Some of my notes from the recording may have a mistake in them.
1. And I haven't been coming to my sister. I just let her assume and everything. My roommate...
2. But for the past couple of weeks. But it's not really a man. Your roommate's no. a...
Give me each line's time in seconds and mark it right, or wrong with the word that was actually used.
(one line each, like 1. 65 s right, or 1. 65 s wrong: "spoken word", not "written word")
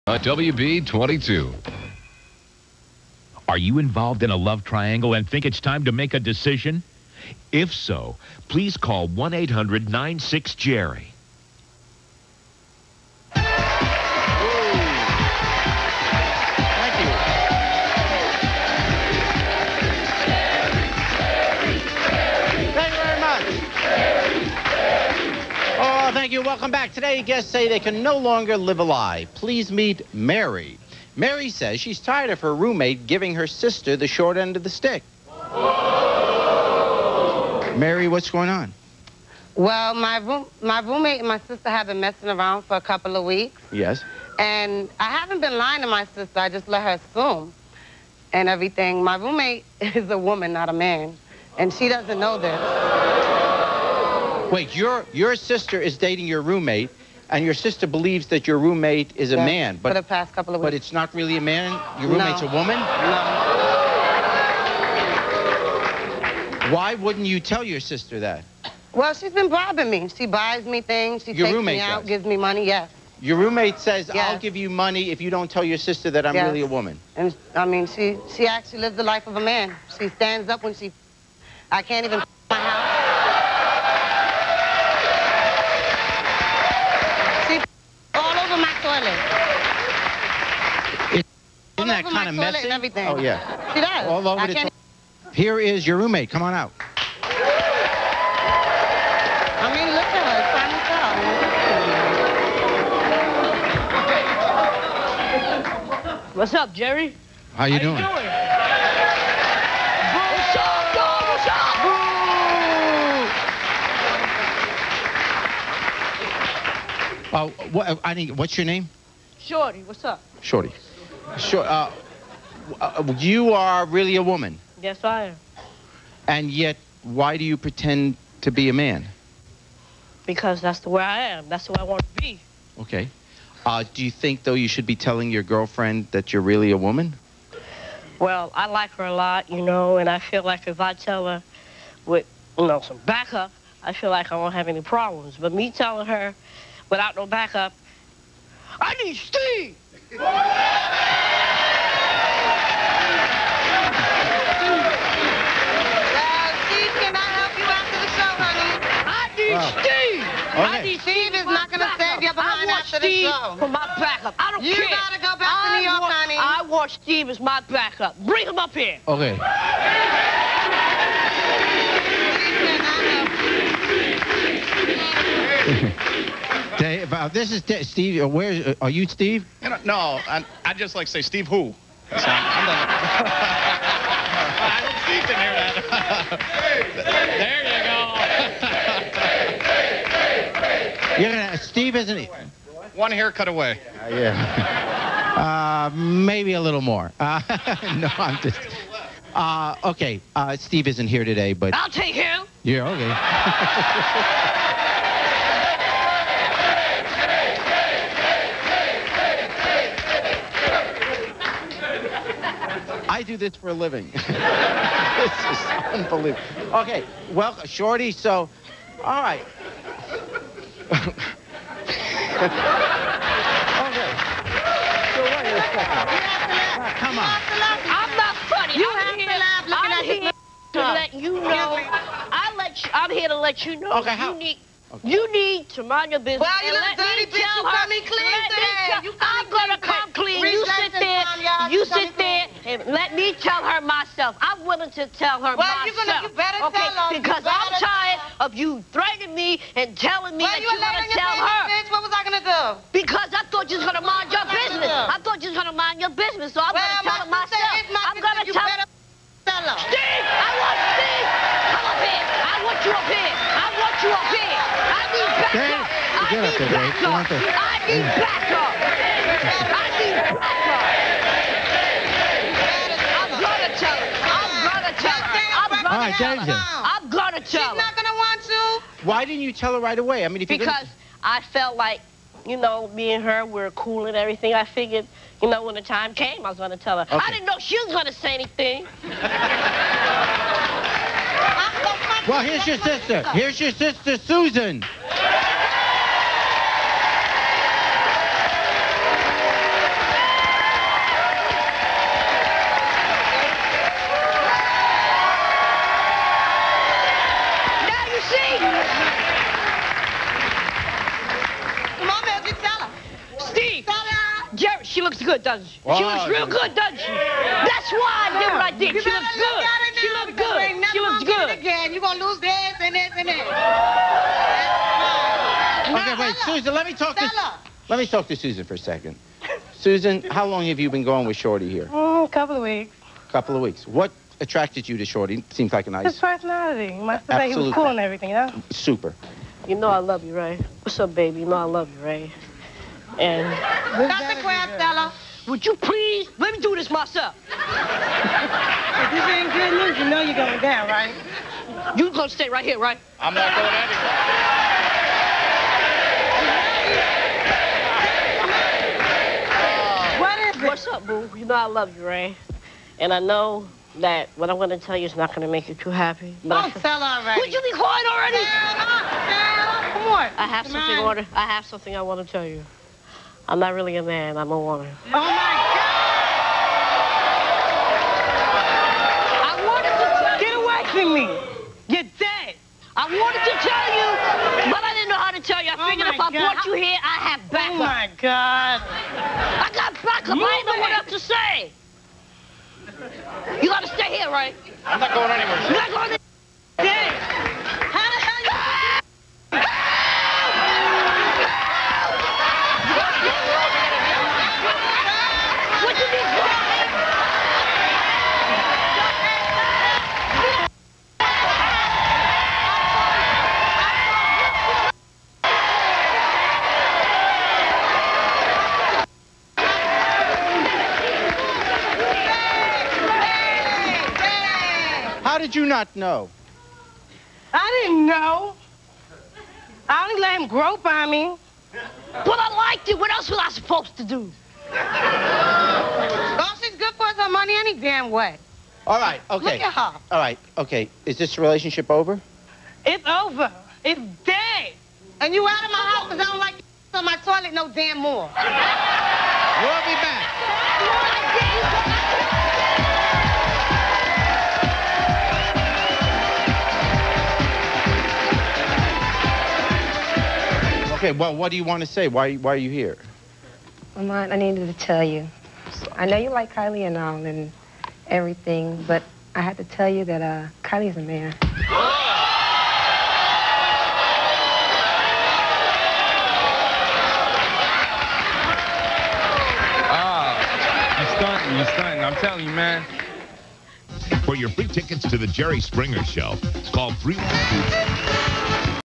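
1. 44 s wrong: "lying", not "coming"
2. 59 s right.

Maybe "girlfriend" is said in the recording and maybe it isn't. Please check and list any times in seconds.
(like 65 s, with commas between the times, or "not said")
135 s.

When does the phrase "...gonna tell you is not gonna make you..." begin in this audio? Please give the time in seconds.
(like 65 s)
364 s.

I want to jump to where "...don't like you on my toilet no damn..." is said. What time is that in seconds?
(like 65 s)
446 s.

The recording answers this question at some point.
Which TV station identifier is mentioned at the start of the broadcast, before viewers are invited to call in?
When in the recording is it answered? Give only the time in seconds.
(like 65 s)
0 s.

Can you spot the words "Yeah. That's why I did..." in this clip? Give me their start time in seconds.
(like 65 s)
317 s.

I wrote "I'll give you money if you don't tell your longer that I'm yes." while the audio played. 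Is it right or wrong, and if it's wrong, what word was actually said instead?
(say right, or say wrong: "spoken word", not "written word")
wrong: "sister", not "longer".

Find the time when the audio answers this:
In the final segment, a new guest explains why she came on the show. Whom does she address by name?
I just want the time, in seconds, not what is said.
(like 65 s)
463 s.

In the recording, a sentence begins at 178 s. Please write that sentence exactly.
Uh, where uh, are you, Steve?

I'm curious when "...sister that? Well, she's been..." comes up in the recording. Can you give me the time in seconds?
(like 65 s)
67 s.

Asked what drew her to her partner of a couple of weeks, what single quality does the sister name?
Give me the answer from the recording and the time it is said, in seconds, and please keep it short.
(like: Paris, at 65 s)
Personality, at 336 s.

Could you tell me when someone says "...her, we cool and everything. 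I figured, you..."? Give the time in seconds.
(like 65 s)
283 s.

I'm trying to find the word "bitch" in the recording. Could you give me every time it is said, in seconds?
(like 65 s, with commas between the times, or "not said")
237 s, 251 s.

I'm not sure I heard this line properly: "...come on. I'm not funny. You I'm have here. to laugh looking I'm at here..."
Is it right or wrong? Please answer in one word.
right.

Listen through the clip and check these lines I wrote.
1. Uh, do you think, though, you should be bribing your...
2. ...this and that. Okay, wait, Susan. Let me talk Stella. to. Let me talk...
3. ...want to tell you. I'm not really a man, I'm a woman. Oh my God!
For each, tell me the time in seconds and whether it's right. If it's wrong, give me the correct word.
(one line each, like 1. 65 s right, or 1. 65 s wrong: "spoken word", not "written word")
1. 133 s wrong: "telling", not "bribing"
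2. 322 s right
3. 372 s right.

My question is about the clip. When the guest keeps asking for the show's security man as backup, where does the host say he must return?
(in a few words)
New York.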